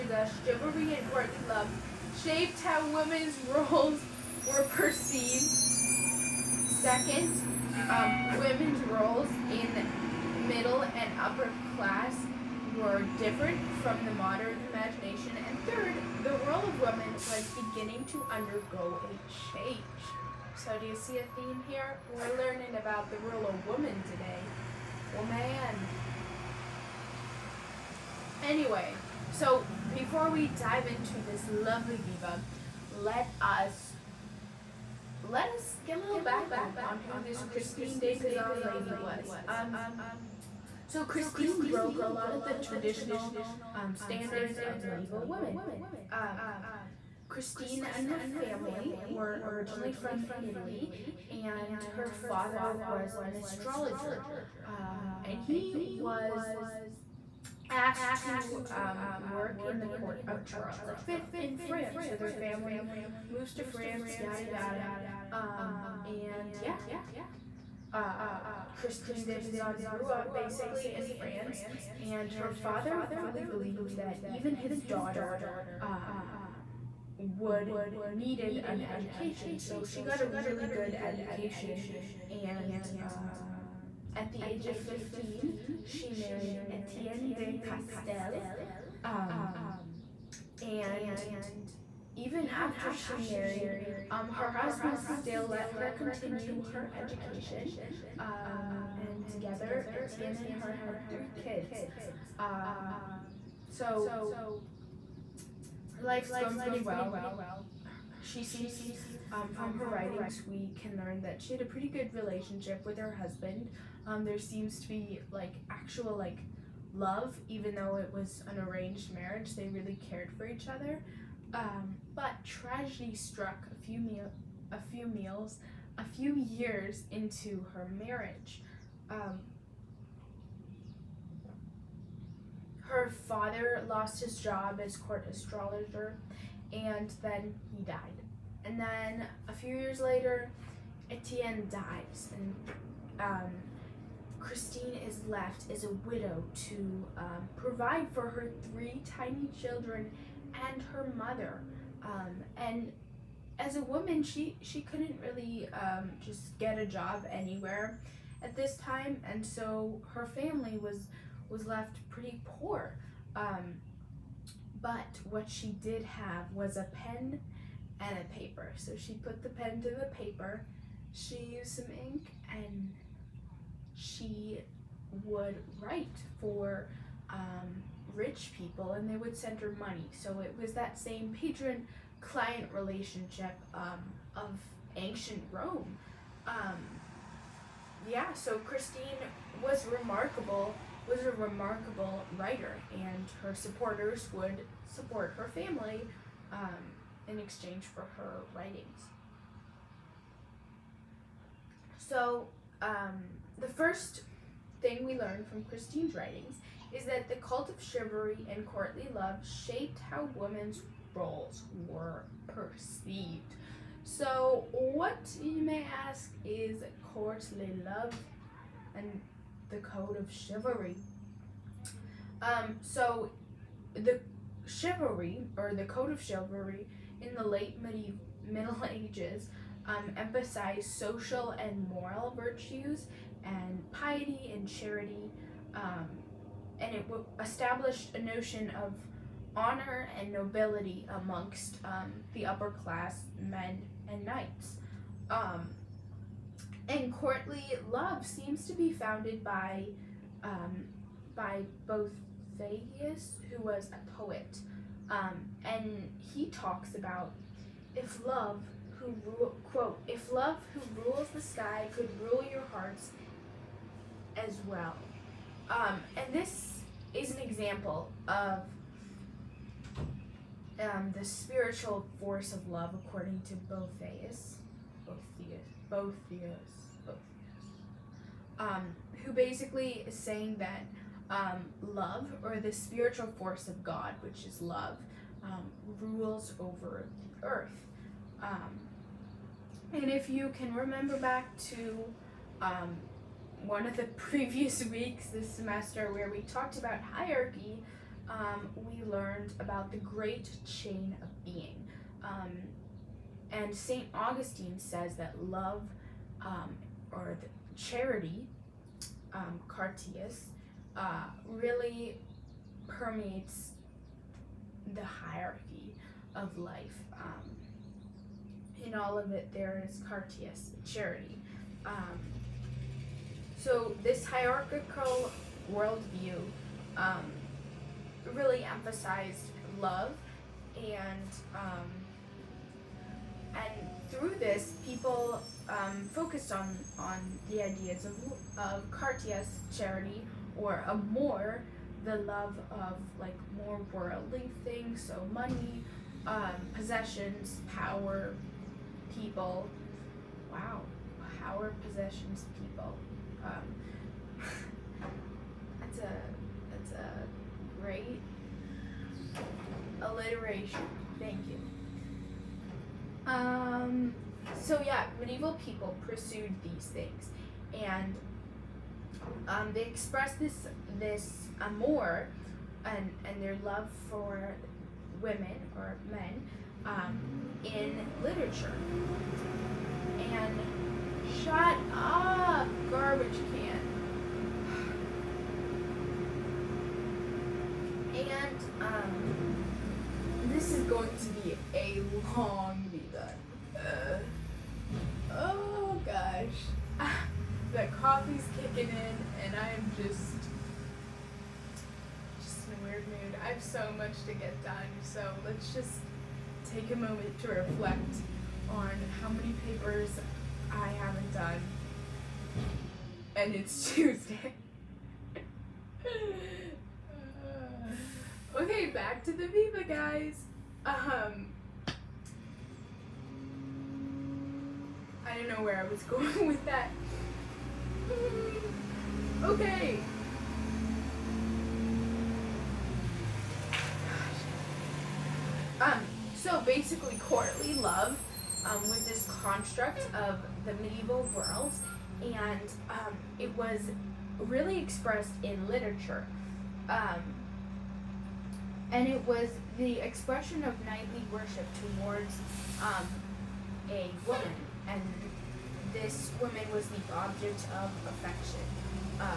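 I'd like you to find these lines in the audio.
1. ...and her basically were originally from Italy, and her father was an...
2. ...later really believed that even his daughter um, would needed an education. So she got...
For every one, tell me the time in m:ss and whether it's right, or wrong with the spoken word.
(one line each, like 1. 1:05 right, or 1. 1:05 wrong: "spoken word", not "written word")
1. 0:47 wrong: "family", not "basically"
2. 1:12 wrong: "father", not "later".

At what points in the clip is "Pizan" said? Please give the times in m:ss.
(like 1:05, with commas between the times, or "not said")
0:38, 1:09.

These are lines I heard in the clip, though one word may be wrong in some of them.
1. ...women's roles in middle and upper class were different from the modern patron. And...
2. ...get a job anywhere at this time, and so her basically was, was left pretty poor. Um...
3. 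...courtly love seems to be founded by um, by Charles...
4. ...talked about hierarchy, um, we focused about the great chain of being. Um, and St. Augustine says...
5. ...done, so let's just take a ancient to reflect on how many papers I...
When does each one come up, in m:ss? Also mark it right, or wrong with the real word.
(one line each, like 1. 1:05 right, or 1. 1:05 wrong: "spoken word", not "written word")
1. 0:08 wrong: "imagination", not "patron"
2. 2:36 wrong: "family", not "basically"
3. 4:07 wrong: "Boethius", not "Charles"
4. 4:56 wrong: "learned", not "focused"
5. 6:44 wrong: "moment", not "ancient".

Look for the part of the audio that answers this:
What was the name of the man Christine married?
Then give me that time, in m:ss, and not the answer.
1:26.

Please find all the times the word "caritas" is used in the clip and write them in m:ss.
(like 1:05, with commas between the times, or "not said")
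5:09, 5:20, 5:38.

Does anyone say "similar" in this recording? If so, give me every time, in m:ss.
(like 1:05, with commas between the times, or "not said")
not said.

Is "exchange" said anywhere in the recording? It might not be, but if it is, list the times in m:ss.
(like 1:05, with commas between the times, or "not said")
3:17.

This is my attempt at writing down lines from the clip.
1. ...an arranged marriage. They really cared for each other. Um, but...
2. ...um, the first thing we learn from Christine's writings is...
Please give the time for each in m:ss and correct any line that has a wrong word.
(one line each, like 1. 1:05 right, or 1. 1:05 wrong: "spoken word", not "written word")
1. 1:58 right
2. 3:22 right.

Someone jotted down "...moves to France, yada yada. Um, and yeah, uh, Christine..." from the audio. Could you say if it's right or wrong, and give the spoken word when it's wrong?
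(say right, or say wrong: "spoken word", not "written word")
right.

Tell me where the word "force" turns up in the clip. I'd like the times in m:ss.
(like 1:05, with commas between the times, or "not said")
4:32, 4:43.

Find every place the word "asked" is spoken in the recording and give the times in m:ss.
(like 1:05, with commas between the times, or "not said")
0:57.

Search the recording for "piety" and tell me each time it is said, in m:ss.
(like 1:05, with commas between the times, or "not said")
3:53.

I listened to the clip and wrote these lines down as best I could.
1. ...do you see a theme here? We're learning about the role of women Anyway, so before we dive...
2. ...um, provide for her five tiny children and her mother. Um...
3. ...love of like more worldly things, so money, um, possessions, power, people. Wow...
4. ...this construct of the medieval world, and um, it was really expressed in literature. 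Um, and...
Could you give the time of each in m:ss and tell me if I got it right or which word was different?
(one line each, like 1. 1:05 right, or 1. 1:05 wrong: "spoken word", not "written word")
1. 0:20 right
2. 2:27 wrong: "three", not "five"
3. 5:42 right
4. 7:19 right.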